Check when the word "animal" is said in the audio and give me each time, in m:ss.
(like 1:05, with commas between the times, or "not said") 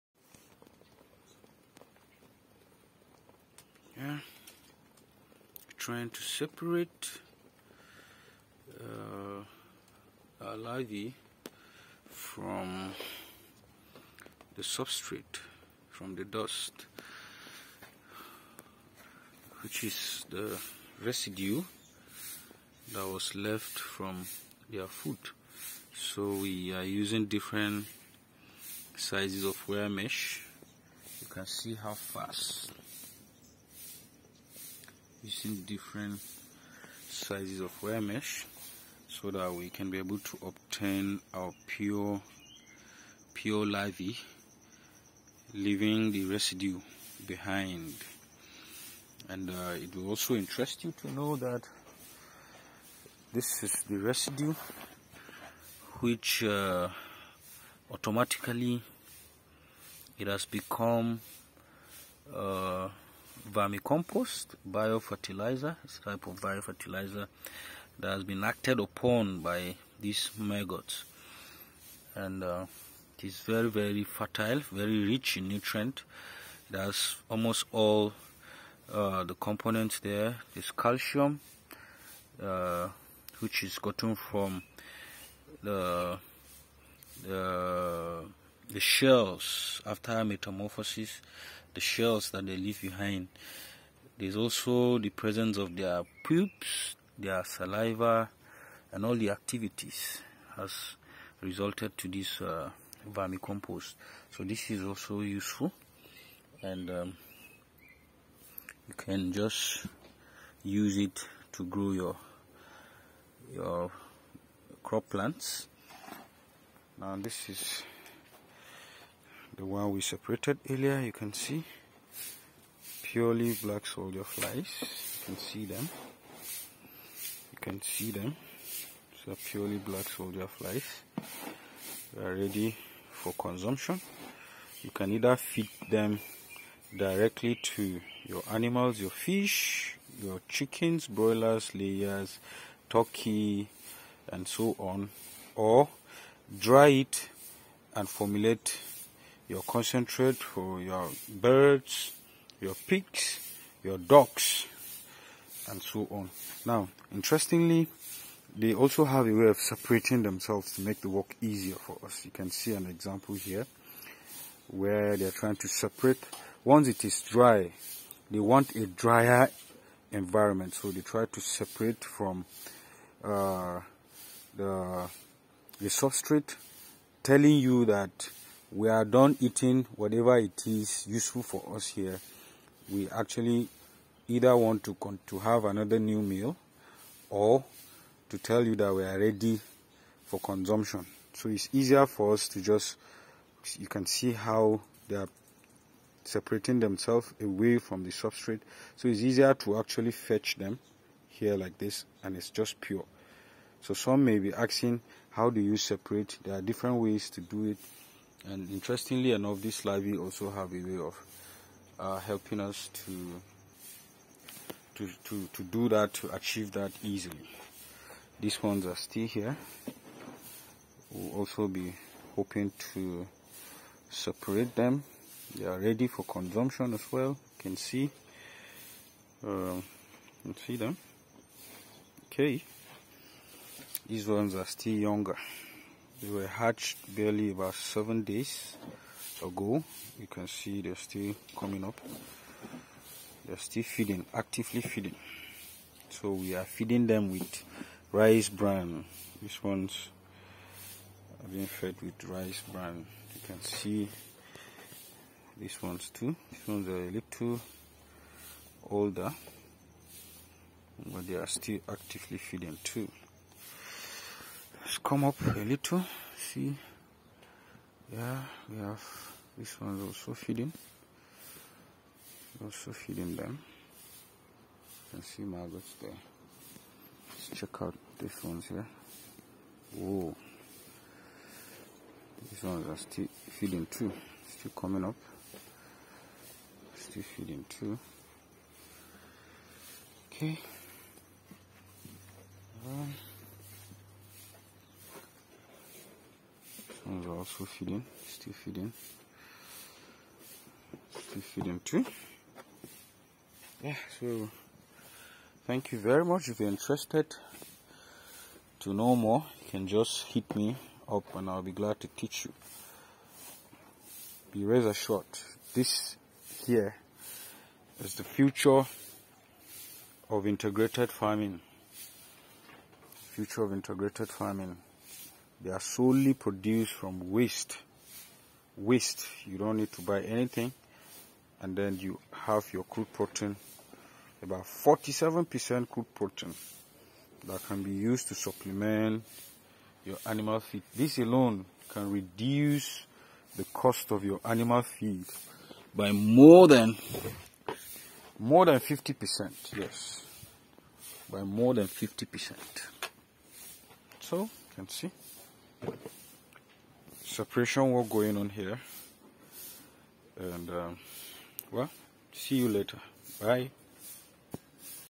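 2:18, 5:40, 5:44.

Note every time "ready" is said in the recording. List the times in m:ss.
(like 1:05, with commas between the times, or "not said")
2:12, 3:09, 3:45.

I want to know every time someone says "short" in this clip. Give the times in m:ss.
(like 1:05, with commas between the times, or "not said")
5:14.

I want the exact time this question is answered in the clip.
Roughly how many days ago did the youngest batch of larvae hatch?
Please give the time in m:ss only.
3:57.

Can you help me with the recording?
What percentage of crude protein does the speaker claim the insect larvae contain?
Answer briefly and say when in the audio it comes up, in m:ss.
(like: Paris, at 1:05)
47%, at 5:34.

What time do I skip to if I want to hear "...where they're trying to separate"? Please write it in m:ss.
2:44.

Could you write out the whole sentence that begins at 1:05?
It's a type of biofertilizer that has been acted upon by these maggots.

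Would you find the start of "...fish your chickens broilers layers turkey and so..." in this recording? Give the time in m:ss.
2:19.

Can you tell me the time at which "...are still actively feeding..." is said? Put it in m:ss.
4:21.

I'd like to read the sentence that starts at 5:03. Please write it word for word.
Yeah, so thank you very much.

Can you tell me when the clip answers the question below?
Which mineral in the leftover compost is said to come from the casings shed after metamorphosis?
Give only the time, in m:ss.
1:20.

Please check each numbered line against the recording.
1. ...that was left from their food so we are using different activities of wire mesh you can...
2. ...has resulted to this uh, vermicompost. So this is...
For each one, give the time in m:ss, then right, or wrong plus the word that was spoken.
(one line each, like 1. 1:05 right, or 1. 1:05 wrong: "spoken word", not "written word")
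1. 0:22 wrong: "sizes", not "activities"
2. 1:40 right.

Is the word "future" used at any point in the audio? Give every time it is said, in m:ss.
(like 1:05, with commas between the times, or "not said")
5:18, 5:23.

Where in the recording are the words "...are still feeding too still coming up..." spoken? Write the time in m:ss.
4:42.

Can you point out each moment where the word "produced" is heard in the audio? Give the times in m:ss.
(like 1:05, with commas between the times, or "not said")
5:26.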